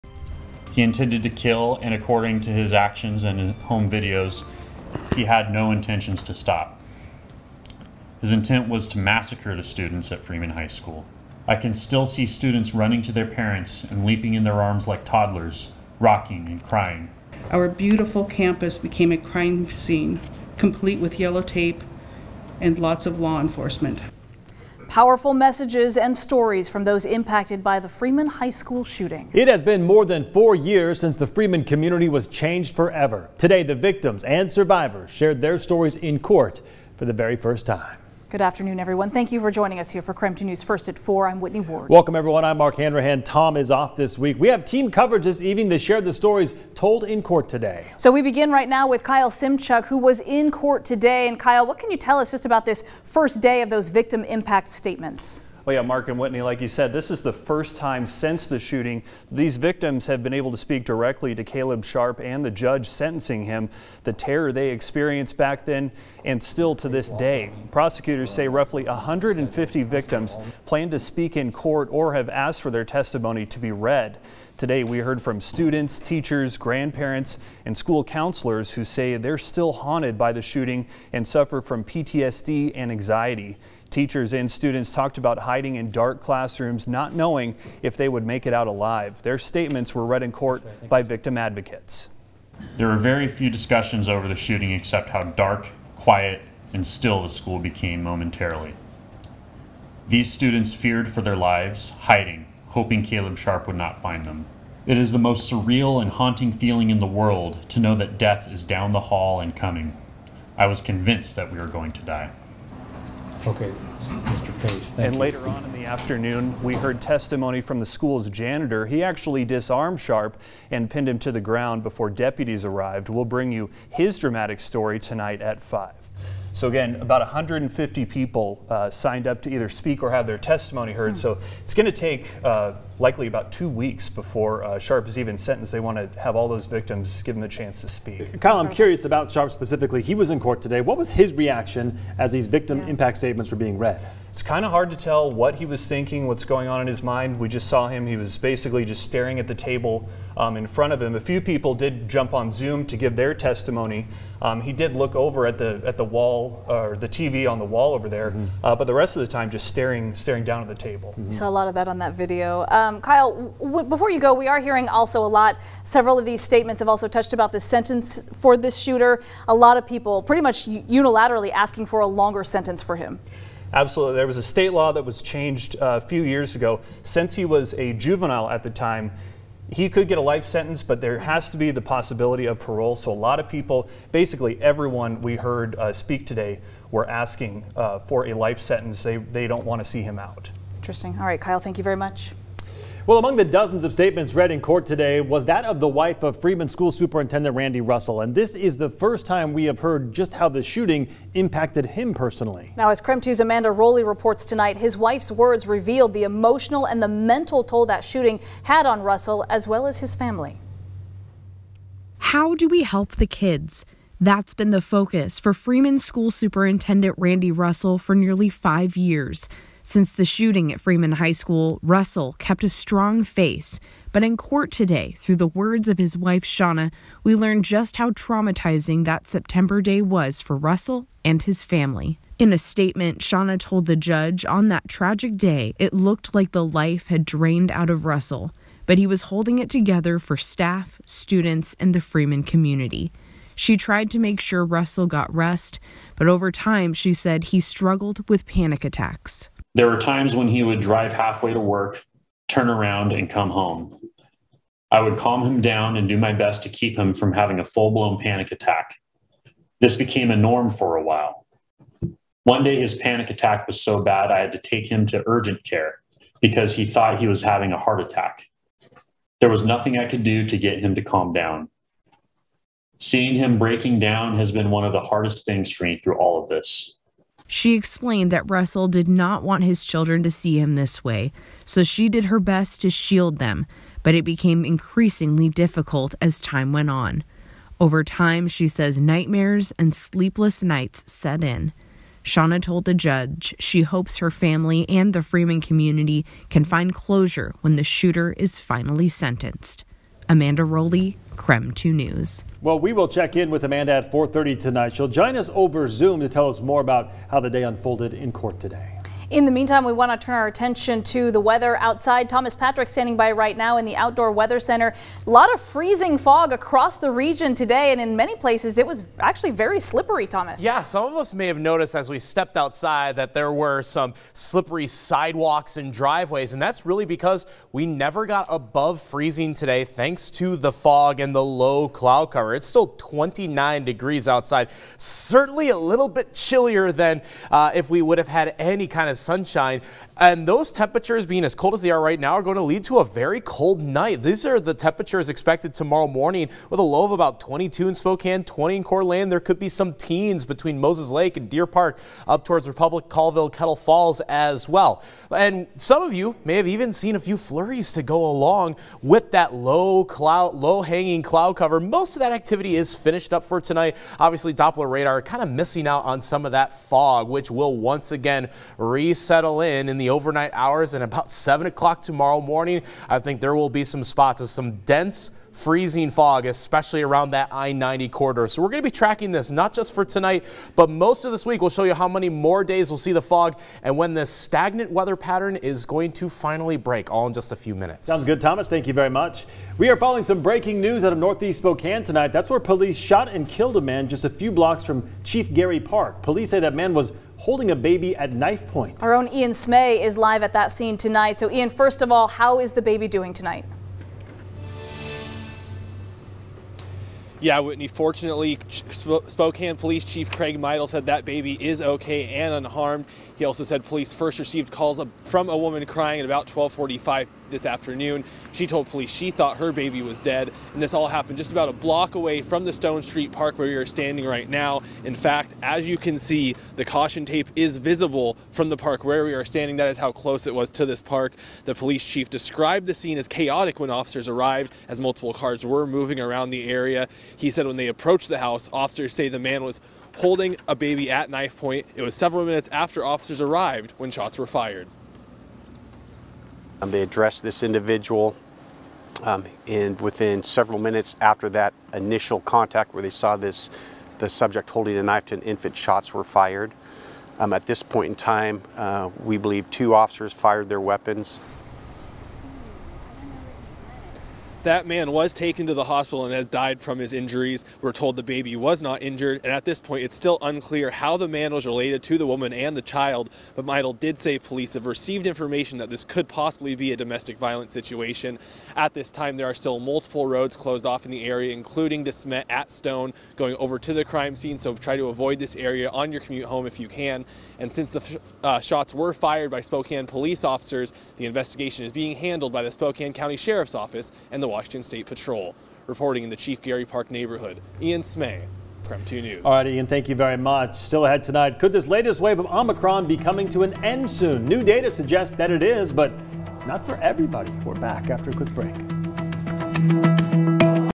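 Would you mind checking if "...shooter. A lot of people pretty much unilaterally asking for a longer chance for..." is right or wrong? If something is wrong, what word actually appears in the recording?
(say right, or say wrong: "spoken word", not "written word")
wrong: "sentence", not "chance".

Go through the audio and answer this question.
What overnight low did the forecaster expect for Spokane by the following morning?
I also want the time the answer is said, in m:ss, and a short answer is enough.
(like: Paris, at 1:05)
22, at 5:47.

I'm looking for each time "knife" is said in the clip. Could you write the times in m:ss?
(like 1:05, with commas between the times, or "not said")
6:38, 7:21, 7:35.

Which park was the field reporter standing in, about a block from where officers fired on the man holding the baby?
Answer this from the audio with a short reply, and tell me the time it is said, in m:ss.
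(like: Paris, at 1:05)
Stone Street Park, at 7:02.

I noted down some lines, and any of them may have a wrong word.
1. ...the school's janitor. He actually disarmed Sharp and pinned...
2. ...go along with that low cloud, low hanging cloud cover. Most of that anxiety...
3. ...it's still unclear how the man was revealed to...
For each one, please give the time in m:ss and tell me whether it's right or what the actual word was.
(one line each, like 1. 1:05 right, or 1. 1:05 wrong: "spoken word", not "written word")
1. 1:57 right
2. 5:58 wrong: "activity", not "anxiety"
3. 7:50 wrong: "related", not "revealed".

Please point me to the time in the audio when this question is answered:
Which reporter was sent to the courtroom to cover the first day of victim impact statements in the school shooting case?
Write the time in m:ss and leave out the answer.
0:49.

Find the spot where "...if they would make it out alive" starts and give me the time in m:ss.
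1:27.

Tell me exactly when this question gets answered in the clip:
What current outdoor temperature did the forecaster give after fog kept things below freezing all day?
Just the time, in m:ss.
5:32.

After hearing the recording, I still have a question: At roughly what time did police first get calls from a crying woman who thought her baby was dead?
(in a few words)
12:45.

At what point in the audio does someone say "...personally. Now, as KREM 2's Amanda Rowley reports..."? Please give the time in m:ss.
3:22.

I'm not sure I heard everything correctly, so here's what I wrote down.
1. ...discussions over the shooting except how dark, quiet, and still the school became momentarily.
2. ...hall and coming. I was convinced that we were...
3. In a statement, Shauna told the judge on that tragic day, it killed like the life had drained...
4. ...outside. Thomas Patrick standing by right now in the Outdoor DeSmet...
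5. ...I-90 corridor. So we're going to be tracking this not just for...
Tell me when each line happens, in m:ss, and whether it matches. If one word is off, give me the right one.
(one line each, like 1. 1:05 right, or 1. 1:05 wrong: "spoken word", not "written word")
1. 1:33 right
2. 1:48 right
3. 3:52 wrong: "looked", not "killed"
4. 5:11 wrong: "Weather", not "DeSmet"
5. 6:17 right.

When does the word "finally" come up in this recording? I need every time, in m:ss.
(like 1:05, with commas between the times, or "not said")
4:58, 6:26.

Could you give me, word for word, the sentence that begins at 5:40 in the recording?
And those temperatures being as cold as they are right now are going to lead to a very cold night.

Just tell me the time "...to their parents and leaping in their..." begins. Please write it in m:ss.
0:13.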